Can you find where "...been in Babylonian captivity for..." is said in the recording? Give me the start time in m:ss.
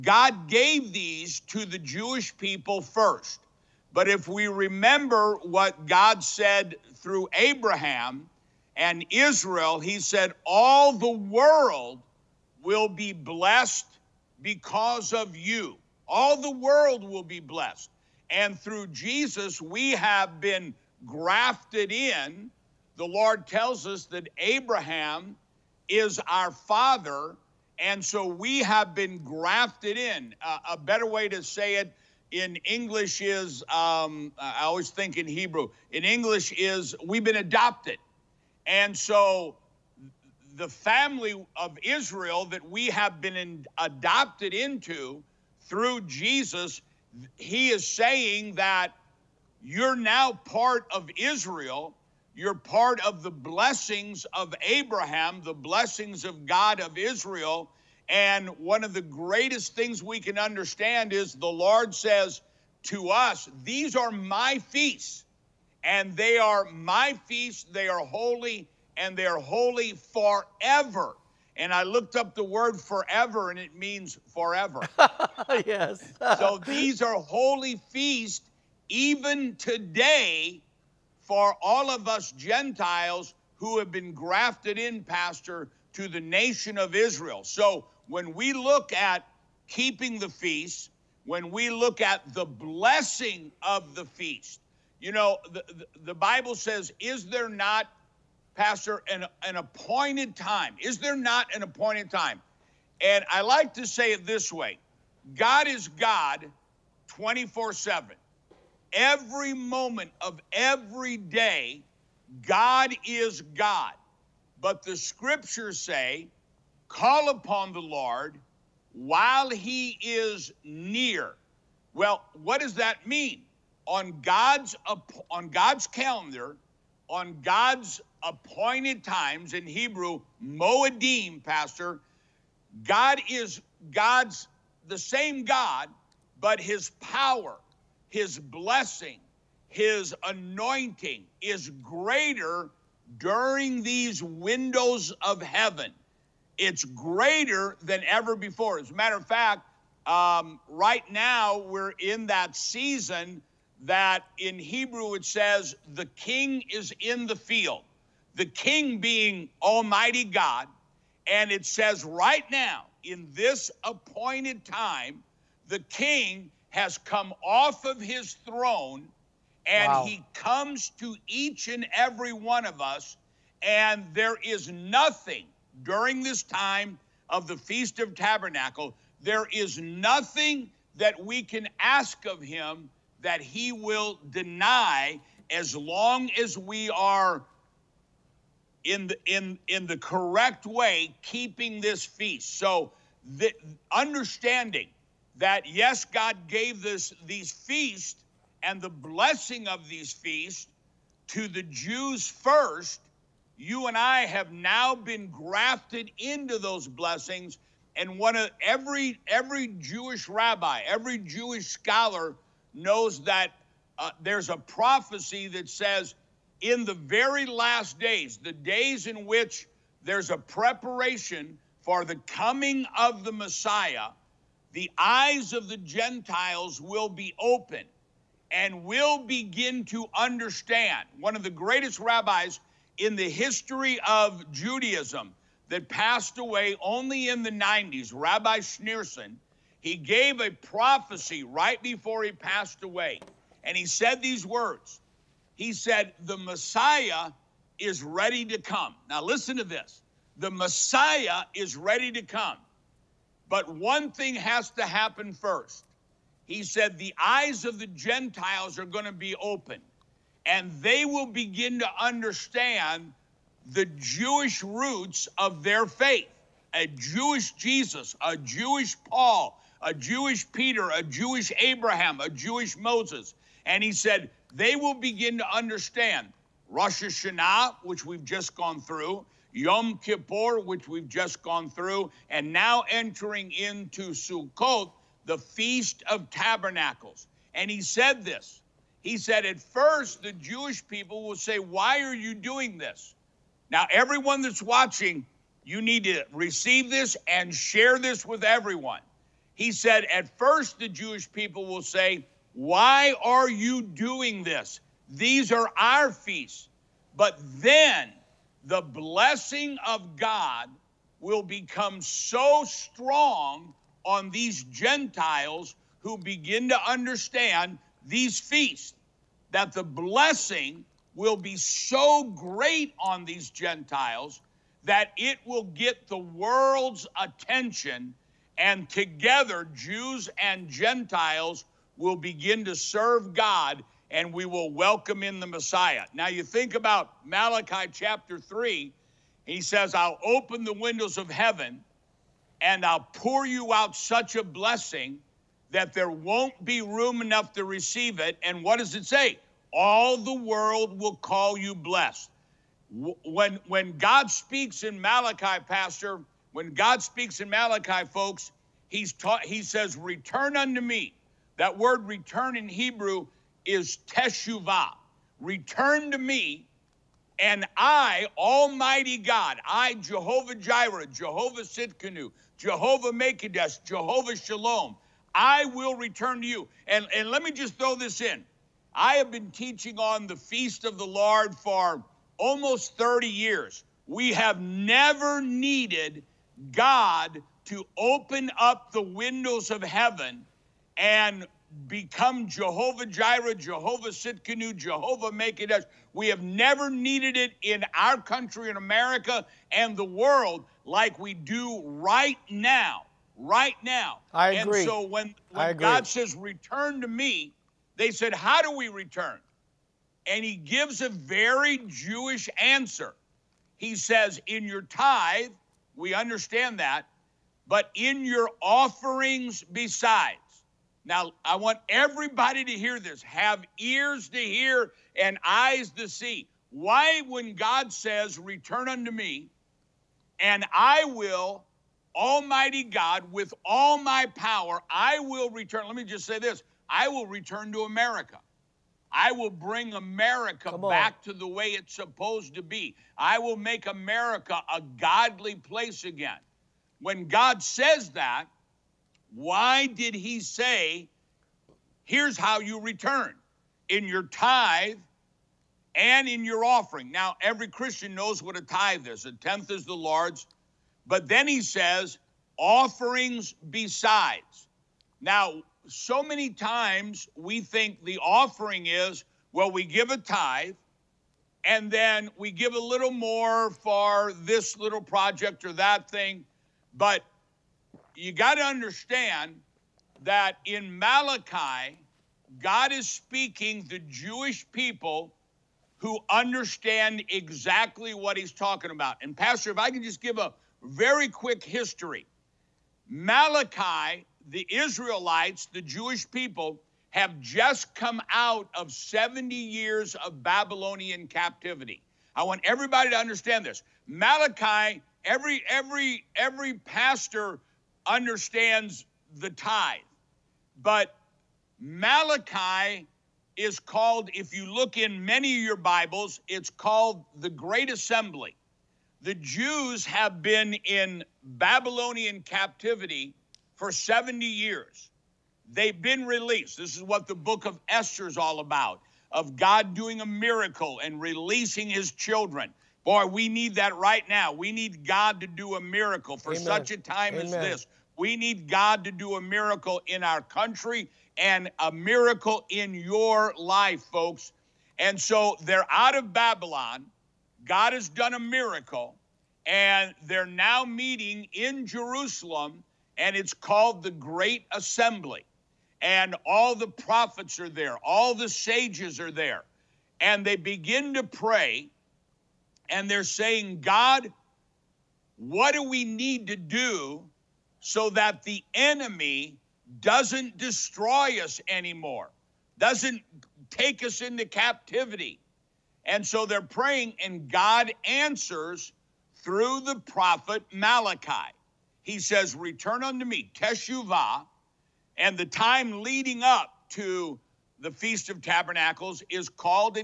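8:40.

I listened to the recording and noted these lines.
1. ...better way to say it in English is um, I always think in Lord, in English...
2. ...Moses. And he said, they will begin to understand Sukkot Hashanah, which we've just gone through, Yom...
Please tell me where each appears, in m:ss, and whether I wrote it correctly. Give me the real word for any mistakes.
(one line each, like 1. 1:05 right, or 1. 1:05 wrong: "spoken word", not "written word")
1. 0:30 wrong: "Hebrew", not "Lord"
2. 4:32 wrong: "Rosh", not "Sukkot".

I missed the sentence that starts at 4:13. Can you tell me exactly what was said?
But one thing has to happen first.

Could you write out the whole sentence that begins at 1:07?
They are holy and they're holy forever.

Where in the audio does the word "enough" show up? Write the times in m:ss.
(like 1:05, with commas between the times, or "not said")
5:47.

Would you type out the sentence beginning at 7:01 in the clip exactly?
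Now, I want everybody to hear this.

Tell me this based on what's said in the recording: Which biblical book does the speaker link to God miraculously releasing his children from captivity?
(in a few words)
Esther.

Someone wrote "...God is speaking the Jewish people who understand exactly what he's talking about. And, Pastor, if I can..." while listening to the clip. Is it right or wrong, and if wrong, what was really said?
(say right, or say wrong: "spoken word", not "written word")
right.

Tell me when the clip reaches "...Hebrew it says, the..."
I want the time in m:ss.
2:34.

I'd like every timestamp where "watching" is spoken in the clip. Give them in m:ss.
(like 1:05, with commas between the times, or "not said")
4:54.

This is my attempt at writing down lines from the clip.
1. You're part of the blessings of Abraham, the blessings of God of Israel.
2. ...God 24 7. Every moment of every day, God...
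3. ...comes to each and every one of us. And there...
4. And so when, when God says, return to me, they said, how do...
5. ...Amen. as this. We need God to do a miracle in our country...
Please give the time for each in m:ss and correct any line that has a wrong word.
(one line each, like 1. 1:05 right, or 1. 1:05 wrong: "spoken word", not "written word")
1. 0:52 right
2. 1:45 right
3. 2:50 right
4. 6:44 right
5. 8:57 right.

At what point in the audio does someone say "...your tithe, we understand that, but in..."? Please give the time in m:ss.
6:54.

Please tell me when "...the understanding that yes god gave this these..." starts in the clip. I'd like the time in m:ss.
3:13.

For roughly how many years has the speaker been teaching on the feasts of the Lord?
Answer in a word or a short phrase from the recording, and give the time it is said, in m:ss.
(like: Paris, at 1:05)
30 years, at 6:22.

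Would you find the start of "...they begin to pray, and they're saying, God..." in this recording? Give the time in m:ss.
9:20.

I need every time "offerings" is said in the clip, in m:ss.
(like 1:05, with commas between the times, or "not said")
6:58, 7:36, 7:42, 7:48.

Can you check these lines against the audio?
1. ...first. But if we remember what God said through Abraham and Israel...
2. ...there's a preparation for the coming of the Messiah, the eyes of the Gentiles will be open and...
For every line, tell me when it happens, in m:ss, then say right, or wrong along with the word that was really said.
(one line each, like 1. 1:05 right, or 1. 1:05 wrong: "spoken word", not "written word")
1. 0:02 right
2. 3:40 right.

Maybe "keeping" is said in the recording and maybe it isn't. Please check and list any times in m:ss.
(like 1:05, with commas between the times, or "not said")
1:29, 3:11.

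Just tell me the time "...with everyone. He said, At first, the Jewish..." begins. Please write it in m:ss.
4:58.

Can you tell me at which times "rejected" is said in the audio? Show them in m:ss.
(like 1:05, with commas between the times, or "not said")
not said.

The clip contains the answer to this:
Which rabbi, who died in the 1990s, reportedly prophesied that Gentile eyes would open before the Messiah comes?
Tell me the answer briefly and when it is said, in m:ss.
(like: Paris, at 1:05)
Rabbi Schneerson, at 3:58.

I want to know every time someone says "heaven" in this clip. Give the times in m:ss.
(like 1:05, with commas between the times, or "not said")
2:25, 5:41, 6:29.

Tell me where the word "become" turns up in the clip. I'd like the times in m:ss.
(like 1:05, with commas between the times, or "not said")
5:11, 6:31.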